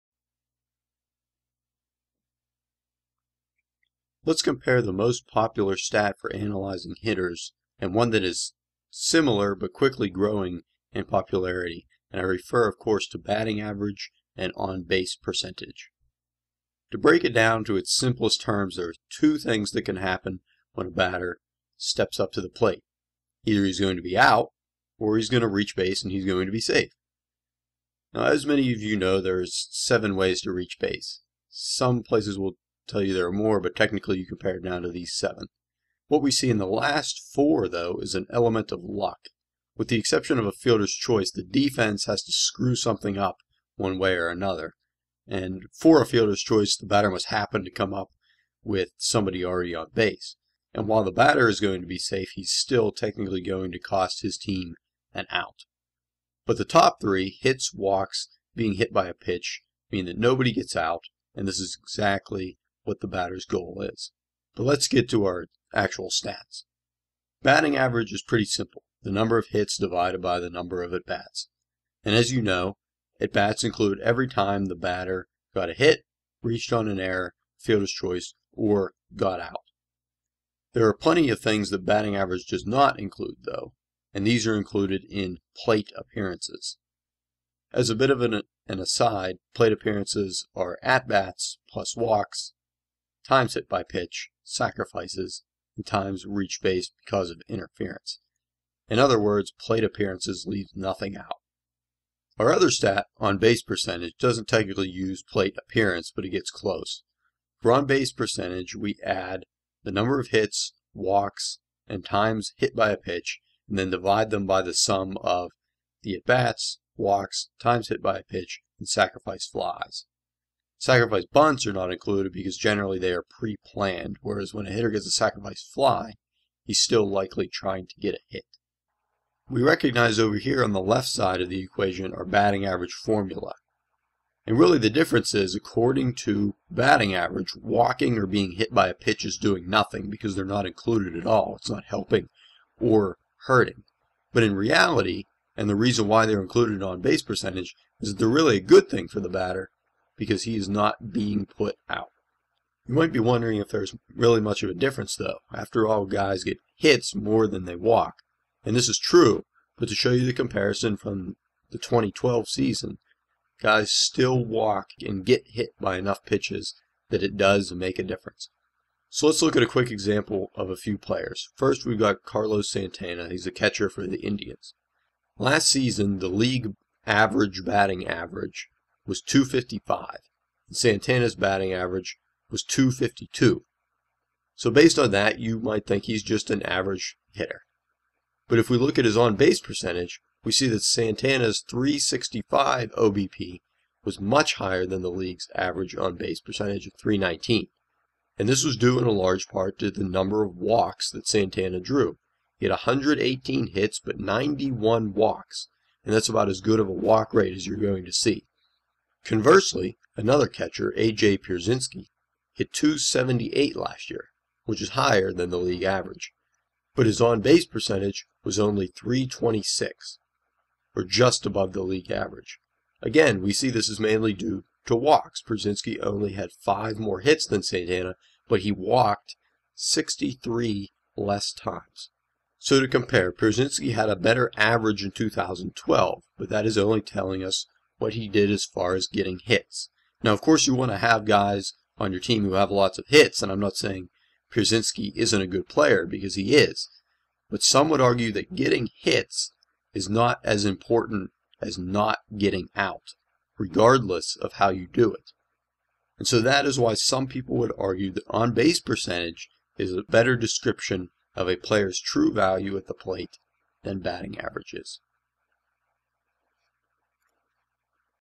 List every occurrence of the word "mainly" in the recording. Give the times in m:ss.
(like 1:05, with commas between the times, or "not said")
3:43.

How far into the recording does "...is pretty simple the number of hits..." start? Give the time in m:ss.
1:08.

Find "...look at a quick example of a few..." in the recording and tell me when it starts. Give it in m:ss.
2:49.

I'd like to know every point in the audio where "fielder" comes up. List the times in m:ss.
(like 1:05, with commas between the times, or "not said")
0:40, 0:46, 1:17.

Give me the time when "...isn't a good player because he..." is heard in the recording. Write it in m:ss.
4:05.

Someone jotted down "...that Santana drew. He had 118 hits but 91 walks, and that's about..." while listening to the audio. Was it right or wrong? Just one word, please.
right.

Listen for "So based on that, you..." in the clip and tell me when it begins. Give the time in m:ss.
3:04.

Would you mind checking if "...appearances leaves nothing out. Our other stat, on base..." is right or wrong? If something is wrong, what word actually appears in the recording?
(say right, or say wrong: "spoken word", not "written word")
right.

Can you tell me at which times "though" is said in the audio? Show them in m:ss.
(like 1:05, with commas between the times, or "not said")
0:37, 1:23, 2:35.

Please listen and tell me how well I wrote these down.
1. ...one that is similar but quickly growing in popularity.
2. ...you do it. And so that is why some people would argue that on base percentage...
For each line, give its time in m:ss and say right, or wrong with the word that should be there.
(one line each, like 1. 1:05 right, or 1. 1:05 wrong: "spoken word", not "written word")
1. 0:07 right
2. 4:14 right.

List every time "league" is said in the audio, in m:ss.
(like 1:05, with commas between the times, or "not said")
2:56, 3:15, 3:35, 3:41.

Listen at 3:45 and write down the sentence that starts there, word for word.
Pierzynski only had five more hits than Santana, but he walked 63 less times.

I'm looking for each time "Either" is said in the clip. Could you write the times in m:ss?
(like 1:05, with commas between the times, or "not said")
0:23.